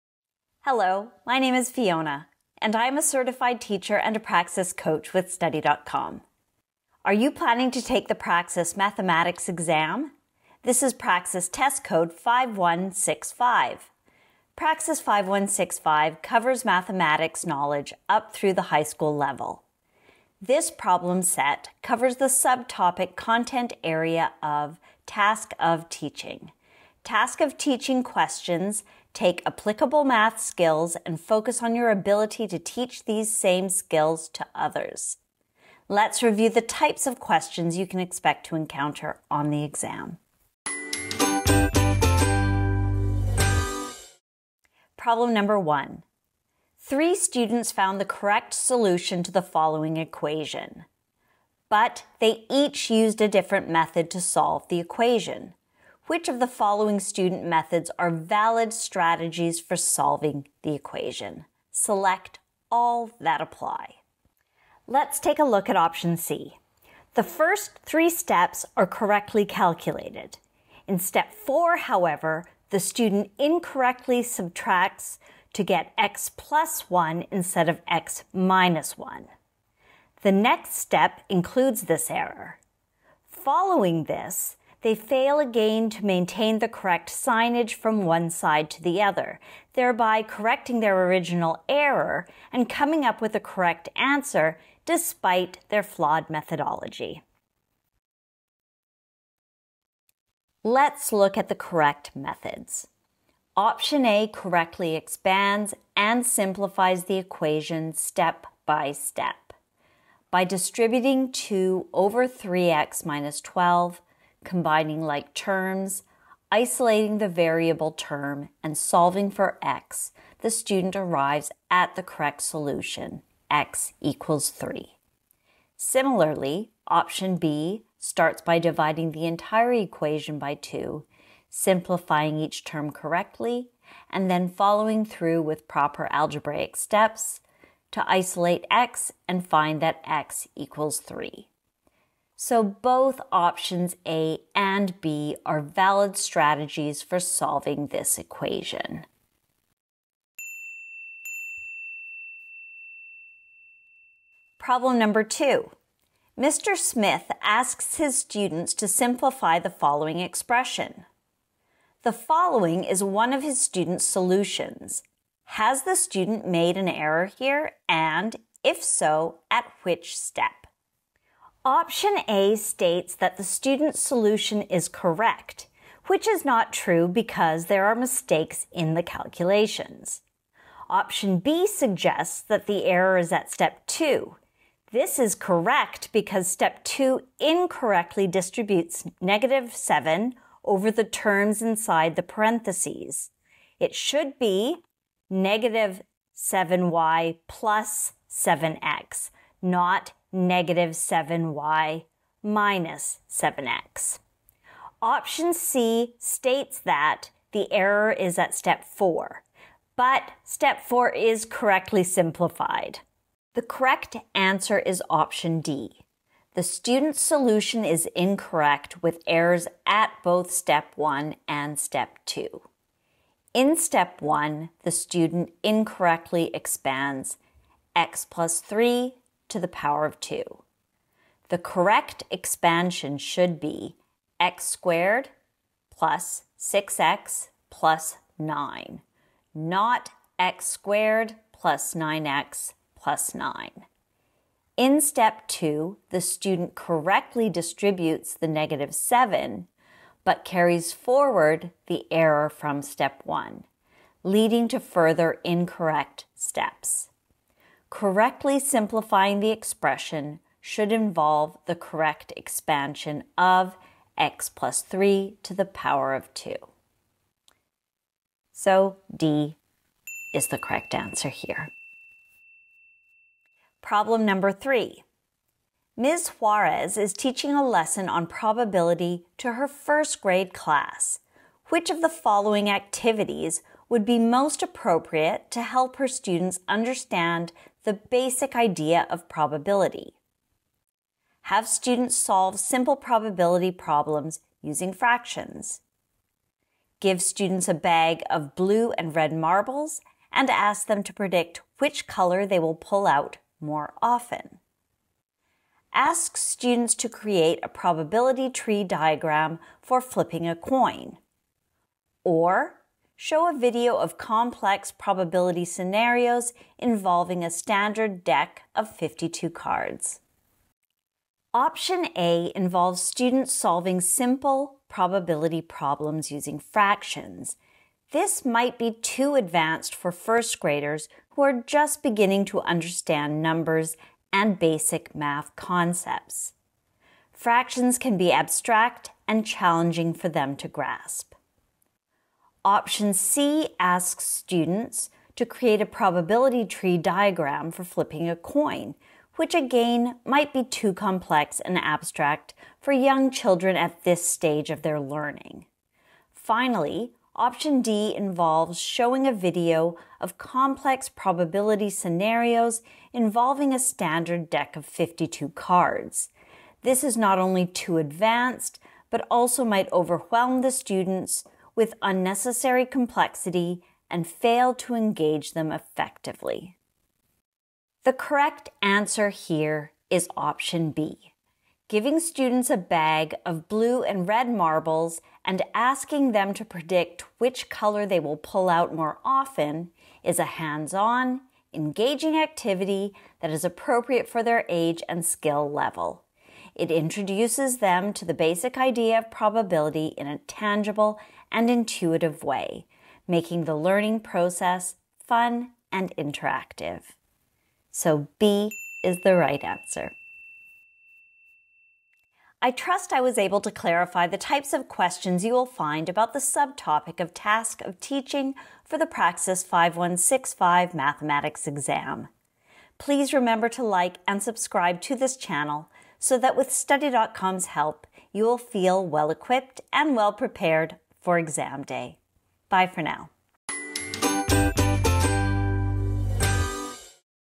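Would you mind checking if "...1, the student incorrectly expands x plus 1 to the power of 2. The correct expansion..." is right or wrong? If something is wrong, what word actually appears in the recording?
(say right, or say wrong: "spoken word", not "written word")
wrong: "3", not "1".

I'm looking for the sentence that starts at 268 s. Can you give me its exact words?
So D is the correct answer here.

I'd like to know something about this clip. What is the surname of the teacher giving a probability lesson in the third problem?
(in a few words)
Juarez.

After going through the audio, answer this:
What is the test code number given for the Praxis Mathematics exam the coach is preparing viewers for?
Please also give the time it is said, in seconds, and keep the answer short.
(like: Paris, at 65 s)
5165, at 11 s.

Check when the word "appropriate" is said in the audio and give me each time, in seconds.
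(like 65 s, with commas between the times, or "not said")
284 s, 393 s.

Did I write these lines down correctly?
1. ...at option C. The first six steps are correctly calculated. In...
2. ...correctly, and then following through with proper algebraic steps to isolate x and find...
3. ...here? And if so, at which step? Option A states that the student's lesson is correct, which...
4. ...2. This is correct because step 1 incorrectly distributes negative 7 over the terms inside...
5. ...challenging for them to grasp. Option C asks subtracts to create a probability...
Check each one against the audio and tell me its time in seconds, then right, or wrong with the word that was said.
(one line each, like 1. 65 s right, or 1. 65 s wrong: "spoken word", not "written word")
1. 65 s wrong: "three", not "six"
2. 132 s right
3. 167 s wrong: "solution", not "lesson"
4. 183 s wrong: "2", not "1"
5. 339 s wrong: "students", not "subtracts".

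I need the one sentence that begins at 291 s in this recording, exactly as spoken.
Have students solve simple probability problems using fractions.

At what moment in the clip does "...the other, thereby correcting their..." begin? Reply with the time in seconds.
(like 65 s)
88 s.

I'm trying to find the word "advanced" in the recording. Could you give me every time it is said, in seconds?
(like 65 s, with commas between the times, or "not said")
329 s, 367 s.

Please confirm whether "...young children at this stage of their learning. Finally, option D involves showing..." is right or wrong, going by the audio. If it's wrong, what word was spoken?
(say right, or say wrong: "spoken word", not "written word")
right.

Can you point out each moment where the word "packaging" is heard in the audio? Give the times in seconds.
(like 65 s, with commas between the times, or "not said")
not said.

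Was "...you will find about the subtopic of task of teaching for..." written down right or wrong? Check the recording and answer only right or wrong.
right.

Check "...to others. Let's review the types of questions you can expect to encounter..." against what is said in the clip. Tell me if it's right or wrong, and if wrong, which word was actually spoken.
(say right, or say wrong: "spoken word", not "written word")
right.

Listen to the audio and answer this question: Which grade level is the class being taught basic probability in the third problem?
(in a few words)
first grade.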